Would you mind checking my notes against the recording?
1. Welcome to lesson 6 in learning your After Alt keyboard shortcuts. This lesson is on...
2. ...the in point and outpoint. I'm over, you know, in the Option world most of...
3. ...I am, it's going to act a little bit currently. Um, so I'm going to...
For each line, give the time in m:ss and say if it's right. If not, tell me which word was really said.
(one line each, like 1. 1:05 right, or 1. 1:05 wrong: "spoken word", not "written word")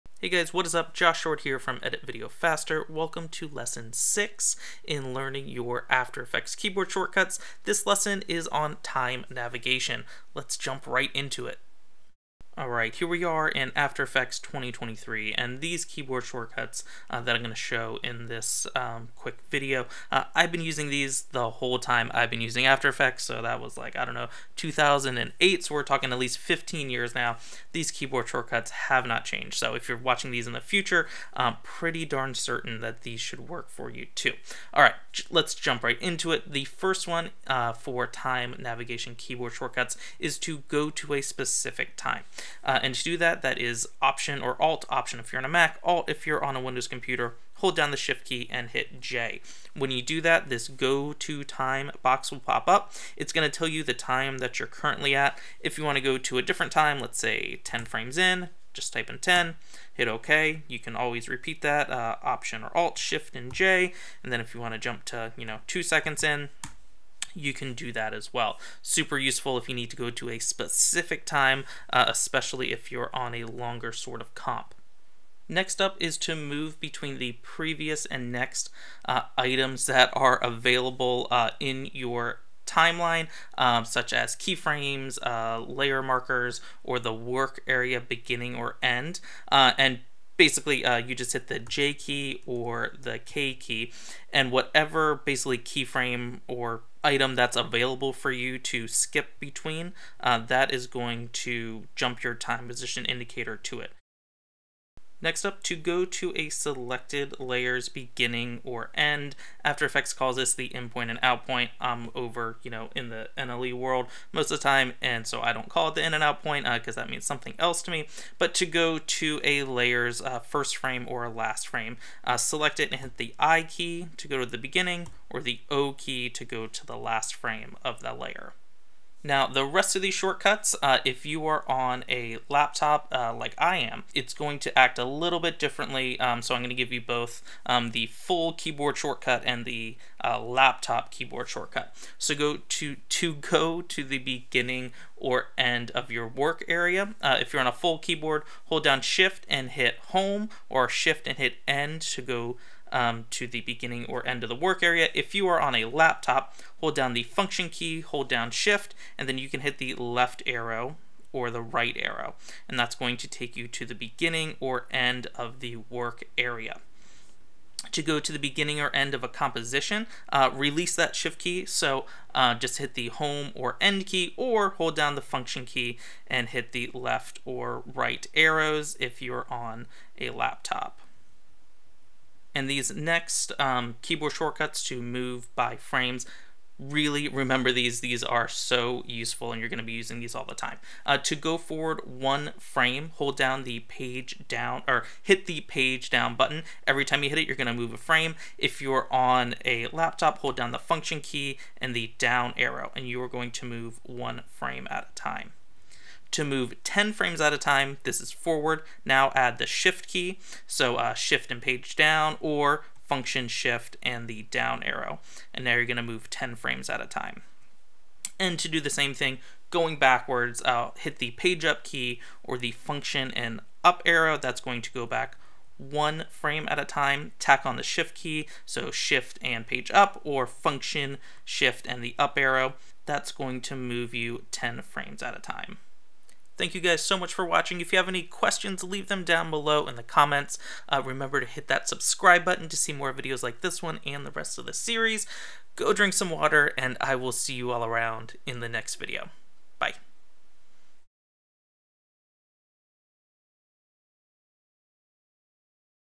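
1. 0:02 wrong: "Effects", not "Alt"
2. 1:50 wrong: "NLE", not "Option"
3. 2:13 wrong: "differently", not "currently".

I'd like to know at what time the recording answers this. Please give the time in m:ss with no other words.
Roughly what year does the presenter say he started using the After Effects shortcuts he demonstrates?
0:24.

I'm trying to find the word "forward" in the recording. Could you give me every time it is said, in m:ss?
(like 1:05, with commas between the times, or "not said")
3:11, 3:28.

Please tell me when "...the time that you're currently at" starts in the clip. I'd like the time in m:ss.
0:53.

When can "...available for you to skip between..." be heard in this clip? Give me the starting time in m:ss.
1:37.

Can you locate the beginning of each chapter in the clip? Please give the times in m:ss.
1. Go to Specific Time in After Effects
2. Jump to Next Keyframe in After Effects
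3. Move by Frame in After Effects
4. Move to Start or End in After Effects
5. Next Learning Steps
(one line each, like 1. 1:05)
1. 0:36
2. 1:15
3. 3:03
4. 1:45
5. 3:56.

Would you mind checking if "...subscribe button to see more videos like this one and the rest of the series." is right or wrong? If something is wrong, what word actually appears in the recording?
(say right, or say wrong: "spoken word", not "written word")
right.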